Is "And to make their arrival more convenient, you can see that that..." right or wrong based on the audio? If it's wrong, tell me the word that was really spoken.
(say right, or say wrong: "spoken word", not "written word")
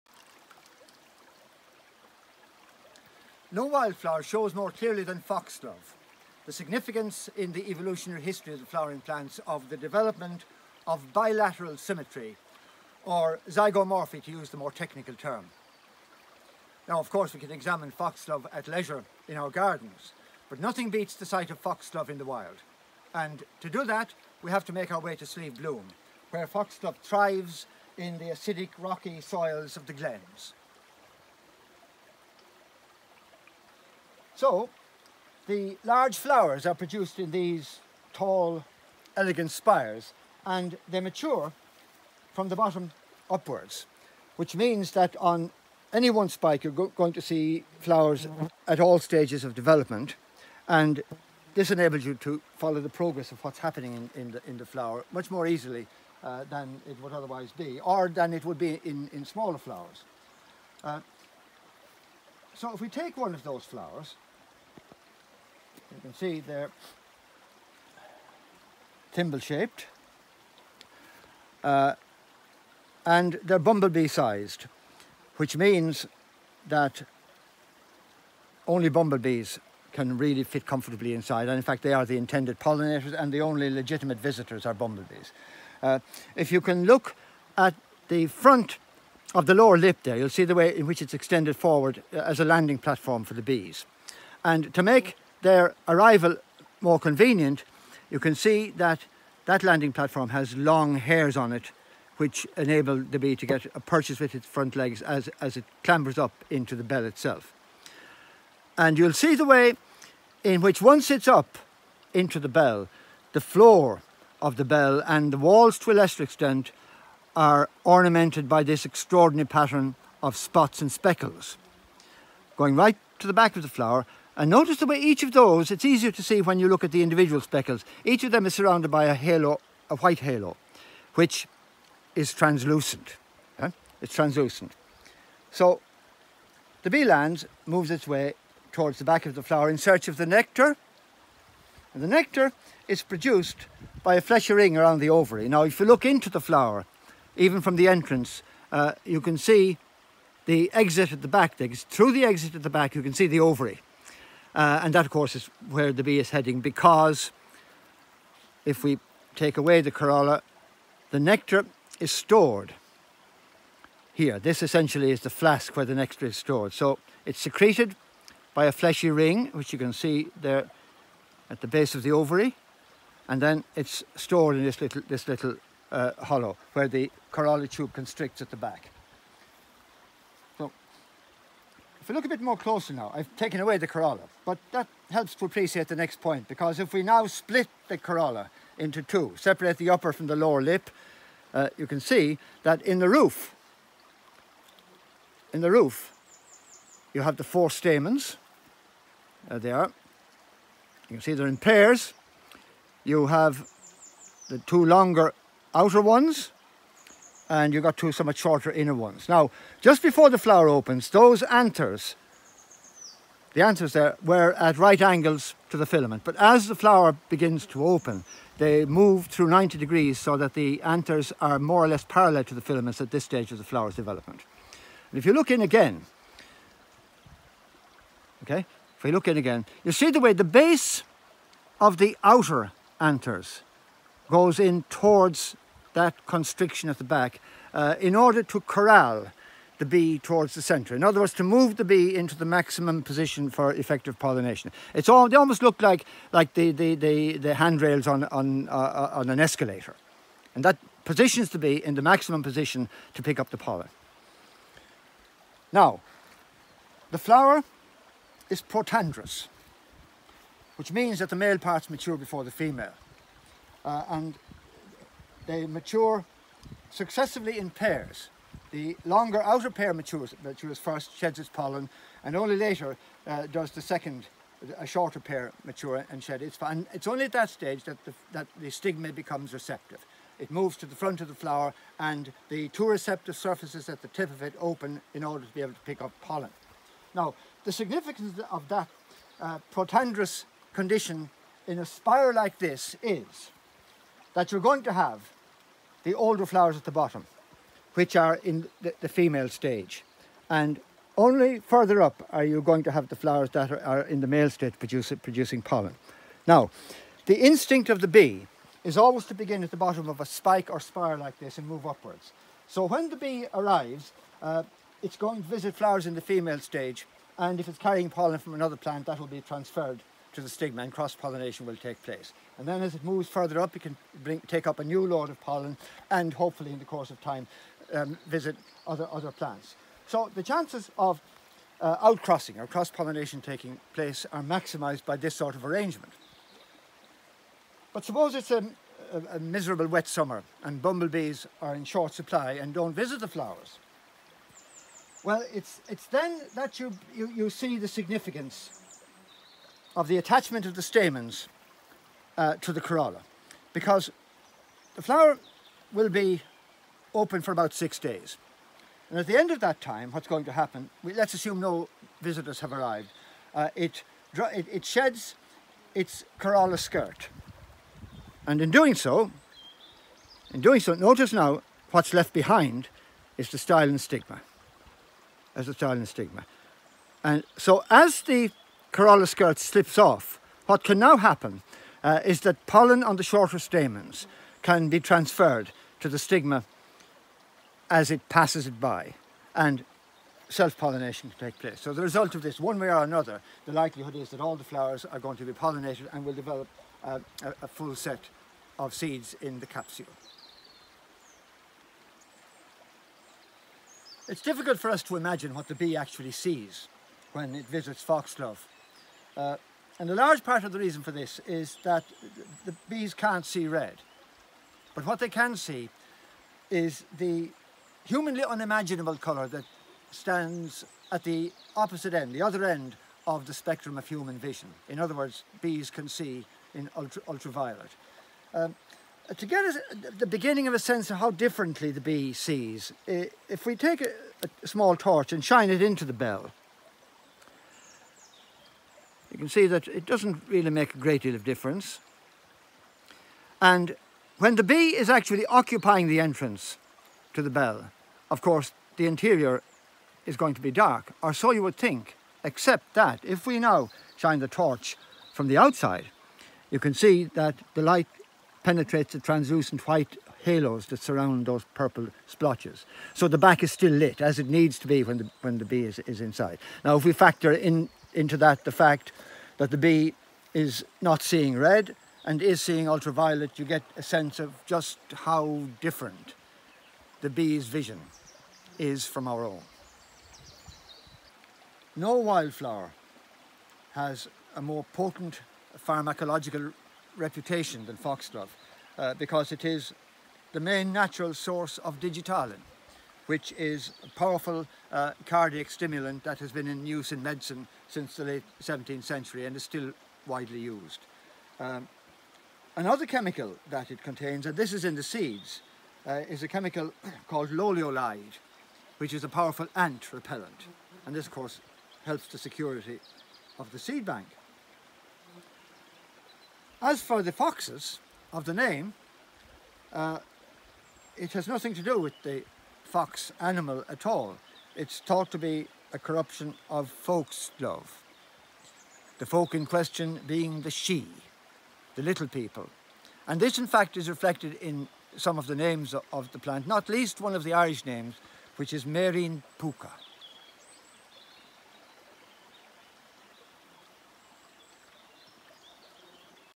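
right.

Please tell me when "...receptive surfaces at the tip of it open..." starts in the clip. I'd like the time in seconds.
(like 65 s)
282 s.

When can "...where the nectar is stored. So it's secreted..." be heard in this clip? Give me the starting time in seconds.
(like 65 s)
165 s.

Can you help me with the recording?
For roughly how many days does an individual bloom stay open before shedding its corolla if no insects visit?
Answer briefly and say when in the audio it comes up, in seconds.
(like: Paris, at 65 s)
6 days, at 357 s.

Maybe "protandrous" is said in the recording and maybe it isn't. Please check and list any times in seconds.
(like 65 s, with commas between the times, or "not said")
258 s, 289 s.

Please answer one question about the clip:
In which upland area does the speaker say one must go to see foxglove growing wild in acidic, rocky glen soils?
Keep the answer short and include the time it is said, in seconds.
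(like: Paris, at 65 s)
Slieve Bloom, at 25 s.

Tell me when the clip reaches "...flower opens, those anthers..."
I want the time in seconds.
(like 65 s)
210 s.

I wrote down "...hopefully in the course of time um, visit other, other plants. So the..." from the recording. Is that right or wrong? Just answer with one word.
right.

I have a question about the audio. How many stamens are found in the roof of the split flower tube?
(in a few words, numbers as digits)
4.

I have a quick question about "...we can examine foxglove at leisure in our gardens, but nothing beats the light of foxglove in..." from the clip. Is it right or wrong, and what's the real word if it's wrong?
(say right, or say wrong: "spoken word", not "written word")
wrong: "sight", not "light".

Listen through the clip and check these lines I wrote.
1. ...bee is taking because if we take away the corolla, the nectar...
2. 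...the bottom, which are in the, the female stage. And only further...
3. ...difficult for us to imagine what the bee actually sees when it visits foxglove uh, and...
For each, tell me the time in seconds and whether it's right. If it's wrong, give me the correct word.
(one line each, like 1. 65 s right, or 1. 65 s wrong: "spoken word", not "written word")
1. 156 s wrong: "heading", not "taking"
2. 296 s right
3. 404 s right.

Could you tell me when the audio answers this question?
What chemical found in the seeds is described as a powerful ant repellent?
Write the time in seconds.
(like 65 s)
507 s.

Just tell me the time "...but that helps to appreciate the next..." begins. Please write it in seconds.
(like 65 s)
184 s.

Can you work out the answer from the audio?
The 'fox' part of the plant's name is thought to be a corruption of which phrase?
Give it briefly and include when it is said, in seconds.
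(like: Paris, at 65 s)
folk's love, at 526 s.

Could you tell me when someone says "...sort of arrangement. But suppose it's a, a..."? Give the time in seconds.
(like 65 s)
335 s.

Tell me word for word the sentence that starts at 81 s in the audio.
And in fact, they are the intended pollinators and the only legitimate visitors are bumblebees.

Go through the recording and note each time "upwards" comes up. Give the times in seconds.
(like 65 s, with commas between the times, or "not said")
43 s, 311 s.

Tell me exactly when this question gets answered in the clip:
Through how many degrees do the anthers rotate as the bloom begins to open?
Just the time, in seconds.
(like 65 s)
219 s.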